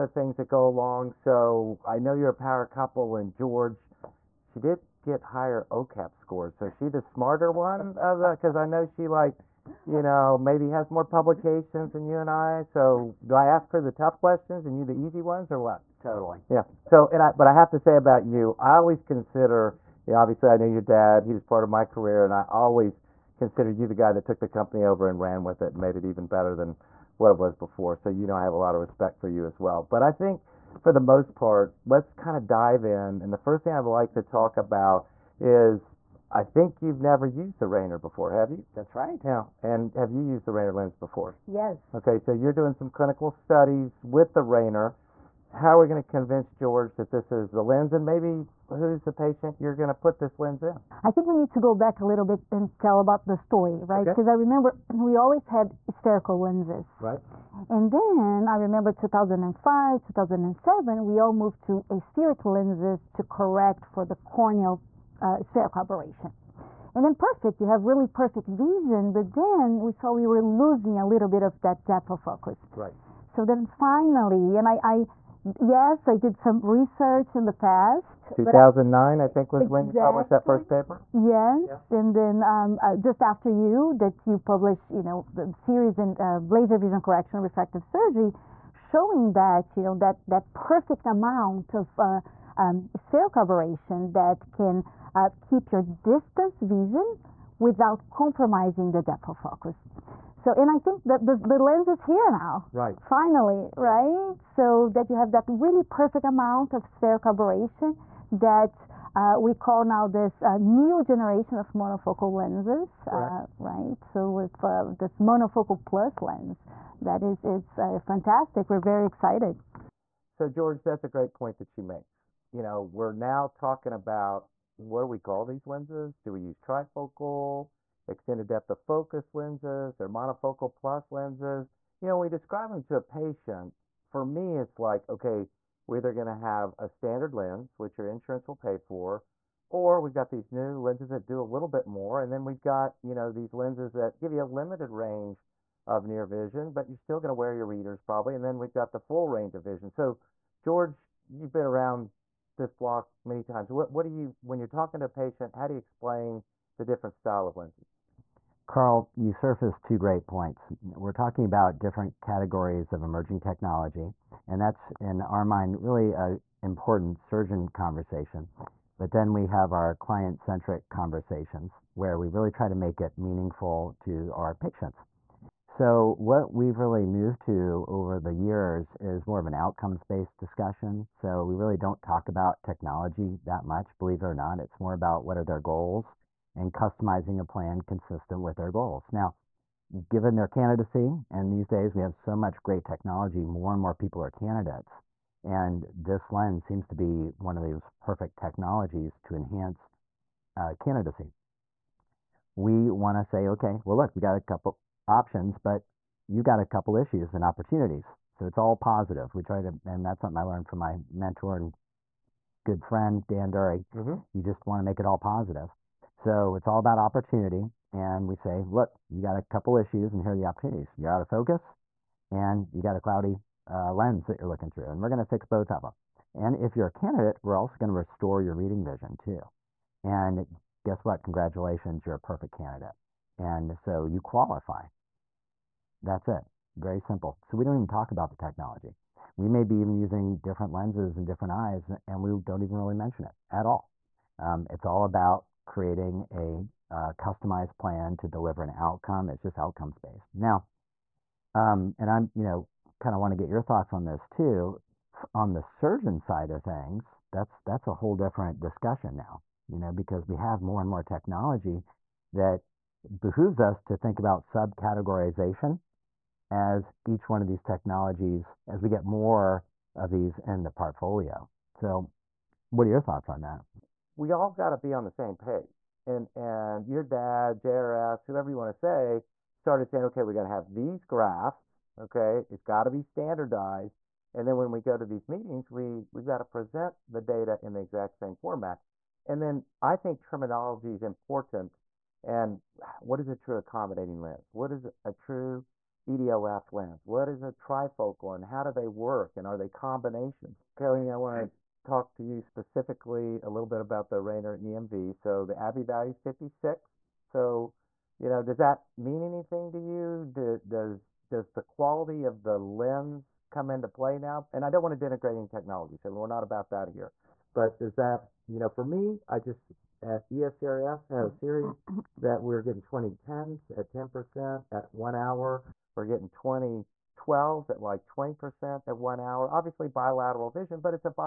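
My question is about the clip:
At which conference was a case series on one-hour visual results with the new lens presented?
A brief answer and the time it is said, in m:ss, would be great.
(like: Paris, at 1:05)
ESCRS, at 5:20.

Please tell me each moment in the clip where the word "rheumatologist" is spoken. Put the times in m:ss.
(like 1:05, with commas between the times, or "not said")
not said.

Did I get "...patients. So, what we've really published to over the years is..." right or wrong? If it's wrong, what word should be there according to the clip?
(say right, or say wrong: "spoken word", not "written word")
wrong: "moved", not "published".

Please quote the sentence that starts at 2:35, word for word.
How do you explain the different style of lenses?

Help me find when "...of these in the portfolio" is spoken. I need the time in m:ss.
4:29.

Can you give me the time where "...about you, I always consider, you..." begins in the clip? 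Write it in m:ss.
0:17.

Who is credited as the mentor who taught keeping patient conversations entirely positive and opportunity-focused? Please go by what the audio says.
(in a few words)
Dan Durrie.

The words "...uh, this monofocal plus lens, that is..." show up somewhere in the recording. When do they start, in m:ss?
1:54.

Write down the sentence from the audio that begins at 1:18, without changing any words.
2009, I, I, think, was exactly.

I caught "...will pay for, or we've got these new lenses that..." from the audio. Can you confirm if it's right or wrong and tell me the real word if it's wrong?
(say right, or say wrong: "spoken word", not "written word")
right.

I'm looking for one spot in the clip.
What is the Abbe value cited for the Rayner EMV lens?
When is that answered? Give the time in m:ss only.
5:06.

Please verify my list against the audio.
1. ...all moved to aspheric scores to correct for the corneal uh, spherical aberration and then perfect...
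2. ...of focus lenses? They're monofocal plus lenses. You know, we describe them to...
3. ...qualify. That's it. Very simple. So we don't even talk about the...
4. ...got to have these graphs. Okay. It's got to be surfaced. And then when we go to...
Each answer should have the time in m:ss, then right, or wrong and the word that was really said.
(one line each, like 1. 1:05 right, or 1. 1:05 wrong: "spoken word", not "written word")
1. 1:01 wrong: "lenses", not "scores"
2. 2:08 right
3. 3:54 right
4. 4:40 wrong: "standardized", not "surfaced".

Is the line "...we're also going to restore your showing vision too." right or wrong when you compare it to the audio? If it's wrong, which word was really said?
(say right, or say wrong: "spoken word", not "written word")
wrong: "reading", not "showing".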